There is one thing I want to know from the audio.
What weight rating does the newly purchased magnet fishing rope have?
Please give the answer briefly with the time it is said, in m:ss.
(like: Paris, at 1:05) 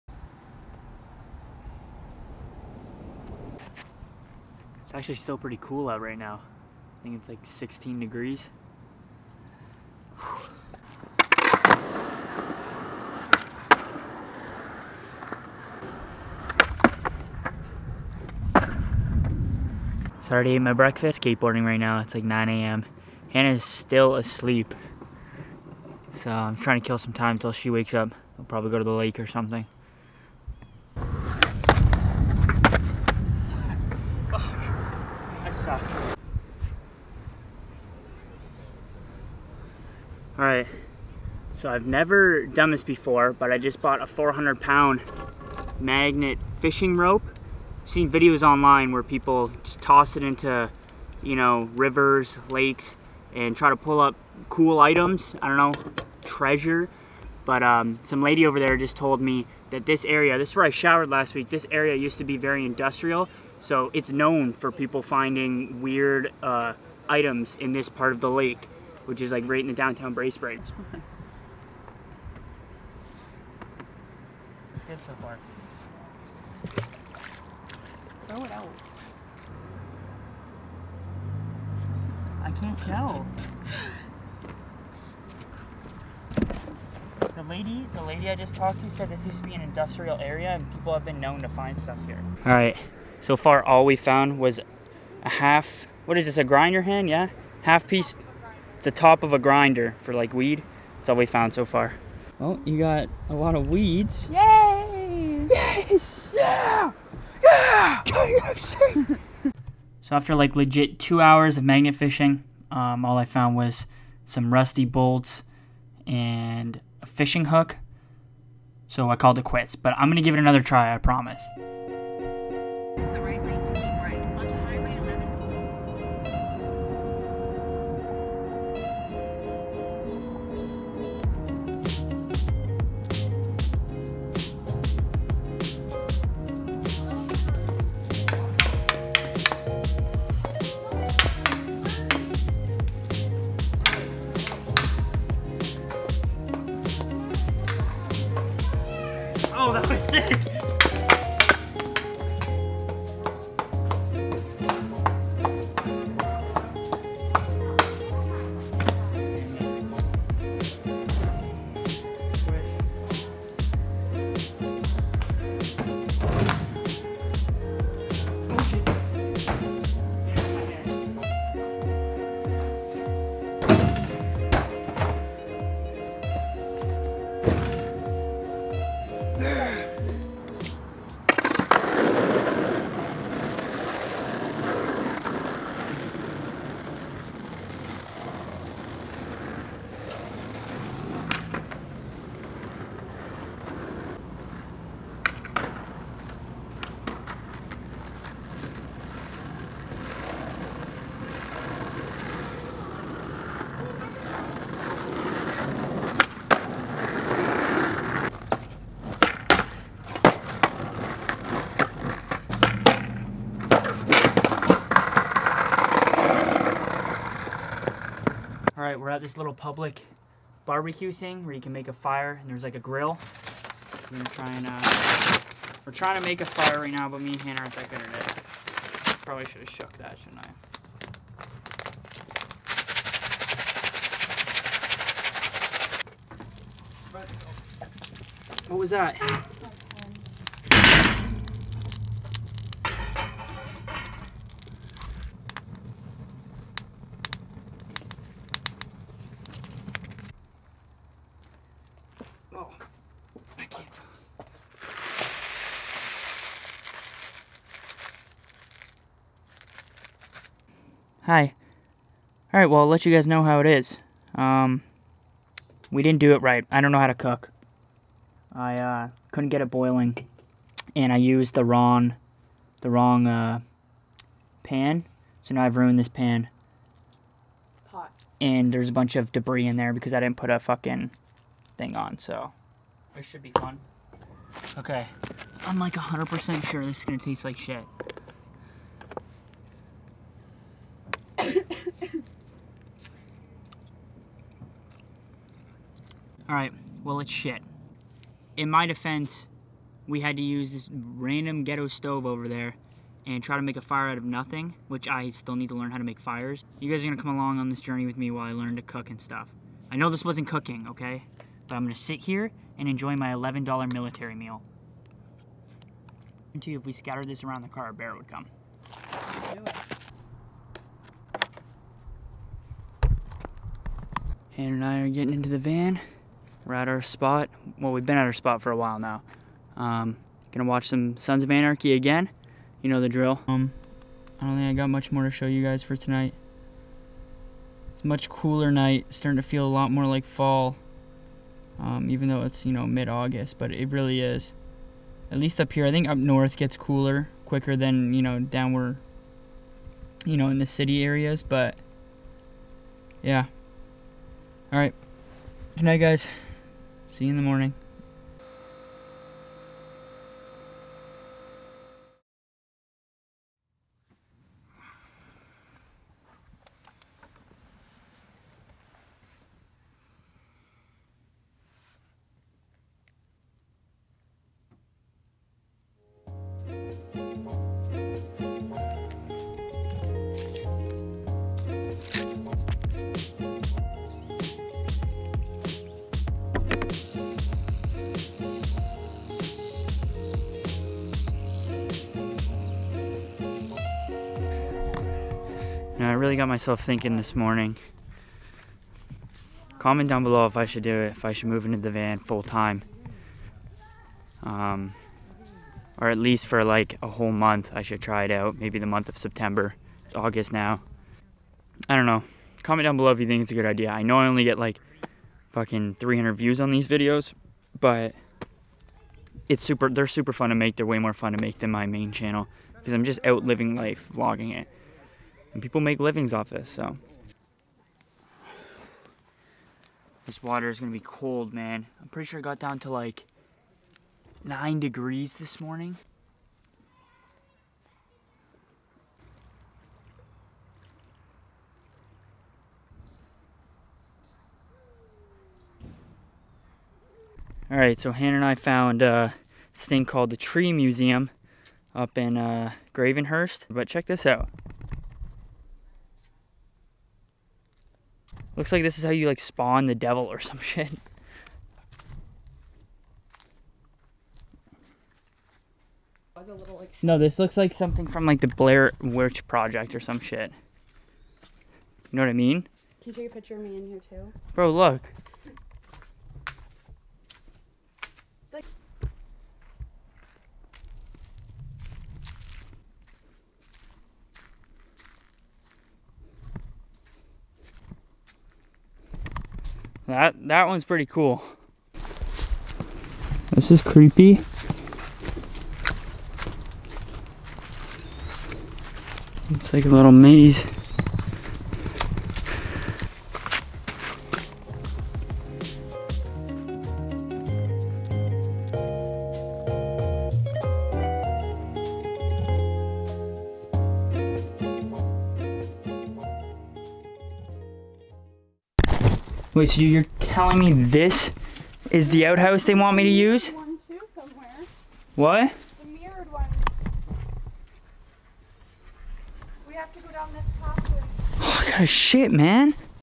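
400 pound, at 0:44.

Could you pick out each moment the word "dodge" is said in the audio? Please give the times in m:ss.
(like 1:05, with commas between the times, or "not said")
not said.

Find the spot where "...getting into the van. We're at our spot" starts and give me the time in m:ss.
5:25.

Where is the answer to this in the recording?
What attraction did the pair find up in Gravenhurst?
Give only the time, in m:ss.
7:30.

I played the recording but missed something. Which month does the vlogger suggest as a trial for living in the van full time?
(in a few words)
September.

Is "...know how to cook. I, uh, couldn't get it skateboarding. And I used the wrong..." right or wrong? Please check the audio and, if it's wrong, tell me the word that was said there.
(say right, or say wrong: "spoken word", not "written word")
wrong: "boiling", not "skateboarding".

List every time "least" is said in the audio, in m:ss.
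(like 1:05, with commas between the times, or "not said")
5:45, 6:46.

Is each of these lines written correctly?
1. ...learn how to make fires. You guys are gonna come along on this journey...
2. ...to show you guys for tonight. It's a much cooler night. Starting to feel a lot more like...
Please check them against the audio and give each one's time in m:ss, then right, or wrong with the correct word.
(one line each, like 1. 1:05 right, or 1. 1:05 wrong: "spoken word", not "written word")
1. 5:05 right
2. 5:35 right.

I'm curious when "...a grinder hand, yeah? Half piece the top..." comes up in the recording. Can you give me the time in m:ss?
1:36.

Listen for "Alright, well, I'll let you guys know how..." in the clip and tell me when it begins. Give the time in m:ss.
4:22.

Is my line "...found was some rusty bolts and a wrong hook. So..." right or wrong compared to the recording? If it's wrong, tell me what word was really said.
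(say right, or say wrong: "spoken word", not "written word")
wrong: "fishing", not "wrong".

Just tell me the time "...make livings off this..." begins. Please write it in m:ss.
7:05.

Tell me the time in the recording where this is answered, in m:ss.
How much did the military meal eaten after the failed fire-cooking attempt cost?
5:13.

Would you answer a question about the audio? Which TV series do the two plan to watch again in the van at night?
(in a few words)
Sons of Anarchy.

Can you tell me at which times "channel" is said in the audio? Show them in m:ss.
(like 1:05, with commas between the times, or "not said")
7:02.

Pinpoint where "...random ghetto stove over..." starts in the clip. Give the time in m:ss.
5:00.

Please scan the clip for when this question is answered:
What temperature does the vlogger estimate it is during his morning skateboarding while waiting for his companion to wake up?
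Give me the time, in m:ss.
0:07.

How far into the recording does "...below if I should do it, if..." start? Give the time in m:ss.
6:40.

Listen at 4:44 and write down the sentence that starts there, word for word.
Okay, I'm like 100% sure this is gonna taste like shit.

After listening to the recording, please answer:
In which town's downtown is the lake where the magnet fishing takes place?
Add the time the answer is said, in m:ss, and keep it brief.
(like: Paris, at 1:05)
Bracebridge, at 1:10.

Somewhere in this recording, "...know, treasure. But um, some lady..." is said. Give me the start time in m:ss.
0:55.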